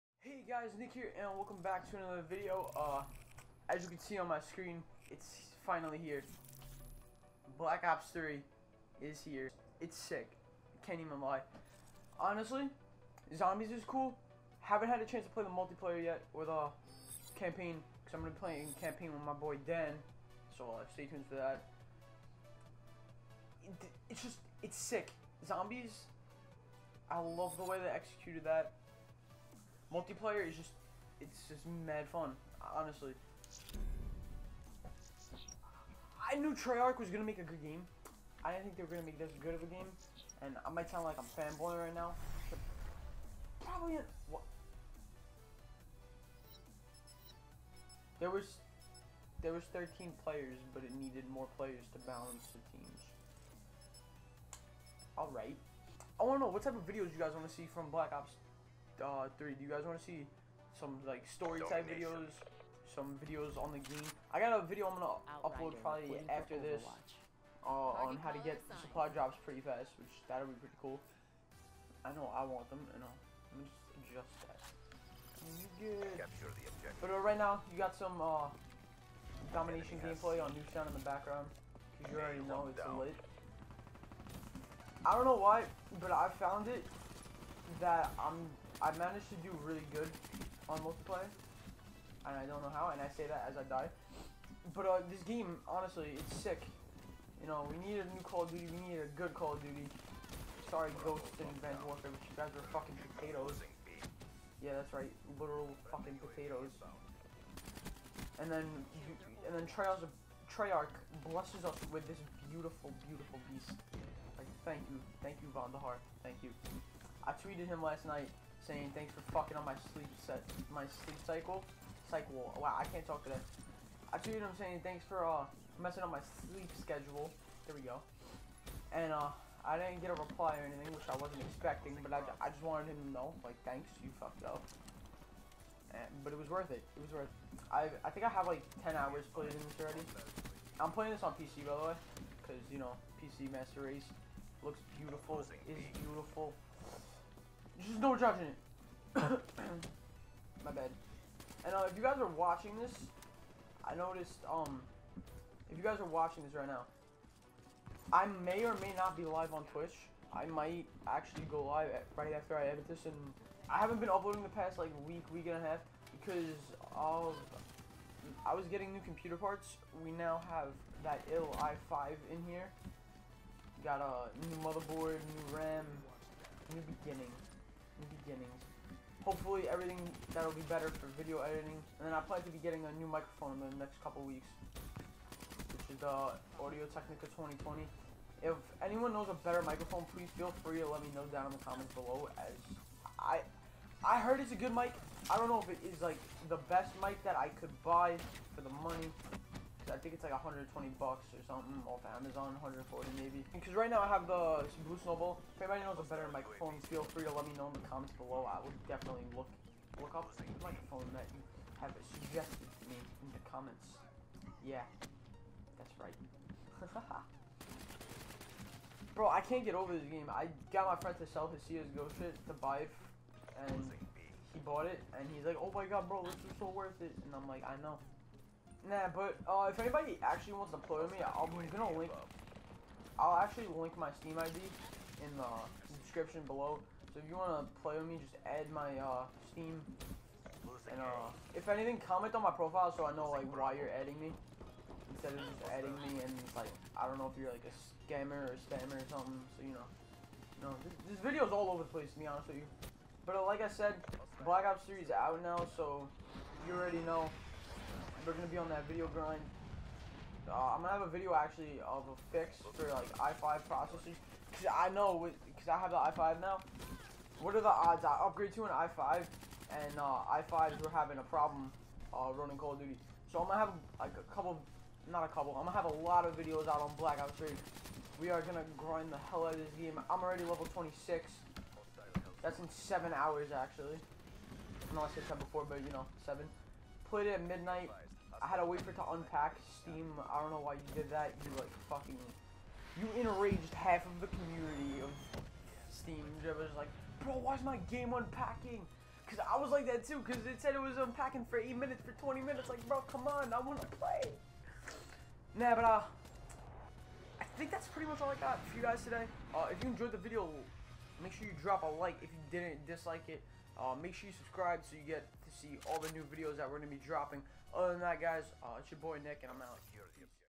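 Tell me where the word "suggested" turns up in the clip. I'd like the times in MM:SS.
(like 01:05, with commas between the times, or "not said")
03:32.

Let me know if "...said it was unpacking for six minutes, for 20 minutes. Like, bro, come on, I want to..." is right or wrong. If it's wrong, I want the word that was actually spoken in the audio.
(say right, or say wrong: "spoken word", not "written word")
wrong: "eight", not "six".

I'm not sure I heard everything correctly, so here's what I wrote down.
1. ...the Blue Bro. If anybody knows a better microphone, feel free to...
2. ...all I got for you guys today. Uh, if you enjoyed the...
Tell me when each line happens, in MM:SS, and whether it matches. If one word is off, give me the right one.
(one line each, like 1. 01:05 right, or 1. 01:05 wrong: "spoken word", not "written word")
1. 03:24 wrong: "Snowball", not "Bro"
2. 05:08 right.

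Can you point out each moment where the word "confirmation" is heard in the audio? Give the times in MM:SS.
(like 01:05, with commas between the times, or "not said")
not said.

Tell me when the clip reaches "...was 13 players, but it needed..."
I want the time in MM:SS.
00:49.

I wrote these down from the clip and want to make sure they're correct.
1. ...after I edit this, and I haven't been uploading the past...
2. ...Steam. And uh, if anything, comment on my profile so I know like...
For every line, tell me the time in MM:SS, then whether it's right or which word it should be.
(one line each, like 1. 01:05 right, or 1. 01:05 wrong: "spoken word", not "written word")
1. 02:42 right
2. 03:59 right.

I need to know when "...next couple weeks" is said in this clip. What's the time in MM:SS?
03:03.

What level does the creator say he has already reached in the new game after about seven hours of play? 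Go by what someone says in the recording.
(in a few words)
26.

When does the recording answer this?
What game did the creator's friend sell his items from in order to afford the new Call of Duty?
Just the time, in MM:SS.
03:41.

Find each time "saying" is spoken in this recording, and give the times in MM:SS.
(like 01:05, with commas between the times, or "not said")
01:58, 02:04.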